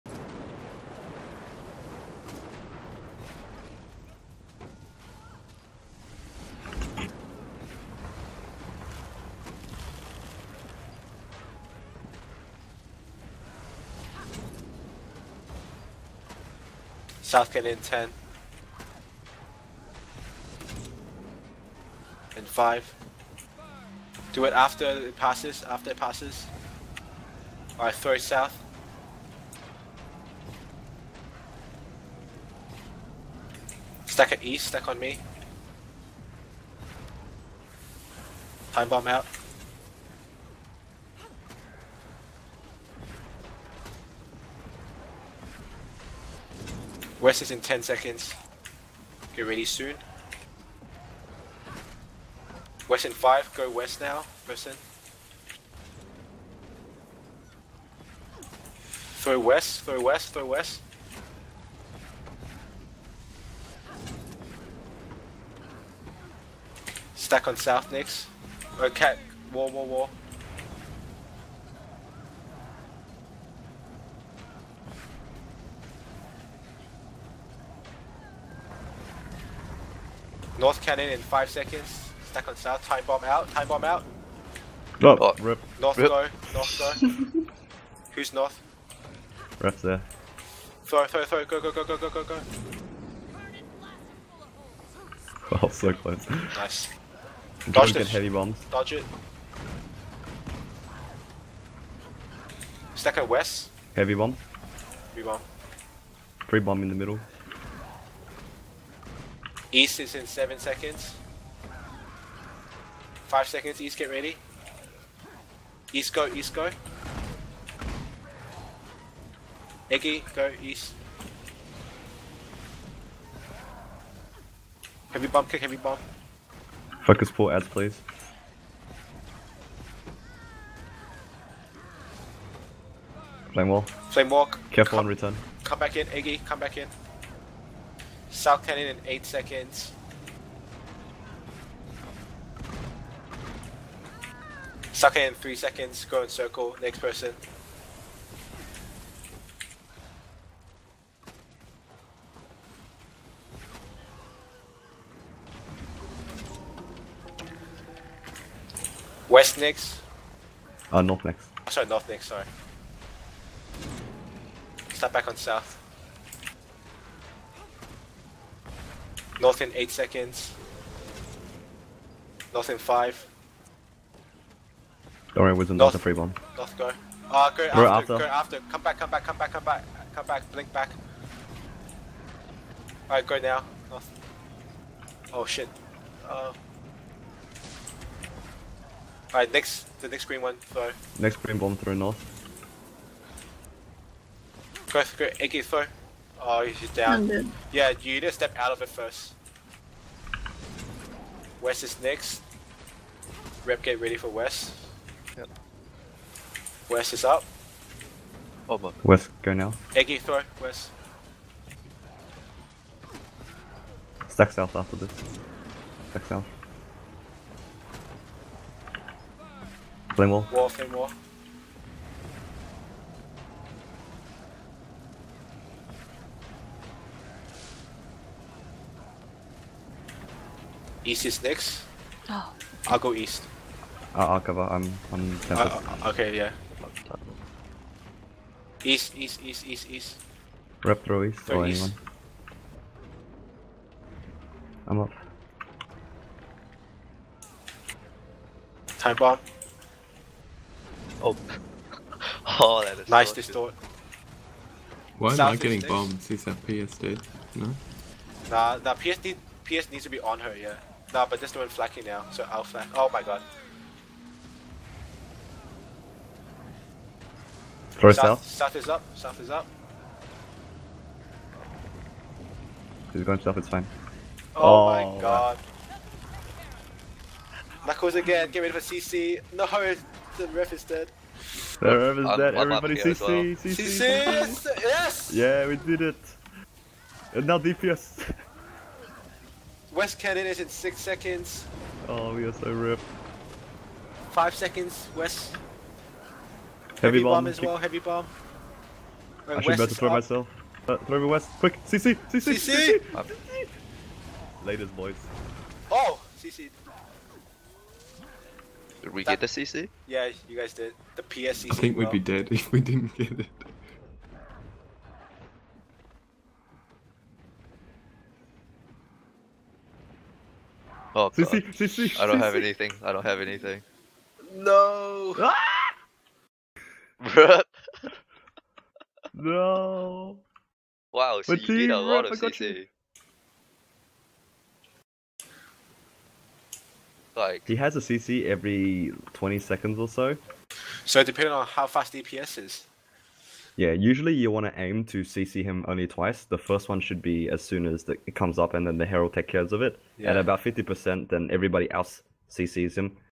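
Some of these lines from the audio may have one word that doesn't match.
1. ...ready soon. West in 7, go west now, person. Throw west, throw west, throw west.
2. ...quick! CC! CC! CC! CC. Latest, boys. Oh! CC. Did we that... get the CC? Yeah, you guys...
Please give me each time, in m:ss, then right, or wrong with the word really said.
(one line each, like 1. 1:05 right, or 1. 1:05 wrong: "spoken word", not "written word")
1. 0:49 wrong: "5", not "7"
2. 5:01 right.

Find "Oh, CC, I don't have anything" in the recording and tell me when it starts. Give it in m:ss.
5:21.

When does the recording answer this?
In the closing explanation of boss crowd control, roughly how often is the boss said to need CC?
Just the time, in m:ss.
5:38.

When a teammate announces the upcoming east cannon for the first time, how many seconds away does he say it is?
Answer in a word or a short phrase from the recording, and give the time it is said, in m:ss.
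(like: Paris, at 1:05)
7 seconds, at 1:50.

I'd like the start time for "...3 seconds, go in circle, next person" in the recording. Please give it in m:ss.
2:25.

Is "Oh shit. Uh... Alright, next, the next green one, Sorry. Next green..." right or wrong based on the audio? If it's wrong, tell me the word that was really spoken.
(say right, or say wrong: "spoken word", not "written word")
right.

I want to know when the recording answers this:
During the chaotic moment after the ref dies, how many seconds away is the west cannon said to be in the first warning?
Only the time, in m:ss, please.
4:50.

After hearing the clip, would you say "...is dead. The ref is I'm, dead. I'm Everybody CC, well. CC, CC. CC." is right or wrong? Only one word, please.
right.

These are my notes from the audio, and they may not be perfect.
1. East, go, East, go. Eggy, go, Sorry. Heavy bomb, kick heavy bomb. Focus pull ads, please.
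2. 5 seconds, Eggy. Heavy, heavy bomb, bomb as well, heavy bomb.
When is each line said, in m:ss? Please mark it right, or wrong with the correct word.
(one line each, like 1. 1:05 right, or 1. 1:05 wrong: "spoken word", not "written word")
1. 1:55 wrong: "East", not "Sorry"
2. 4:54 wrong: "West", not "Eggy".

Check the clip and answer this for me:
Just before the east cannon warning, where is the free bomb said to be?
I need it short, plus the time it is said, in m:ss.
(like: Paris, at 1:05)
The middle, at 1:46.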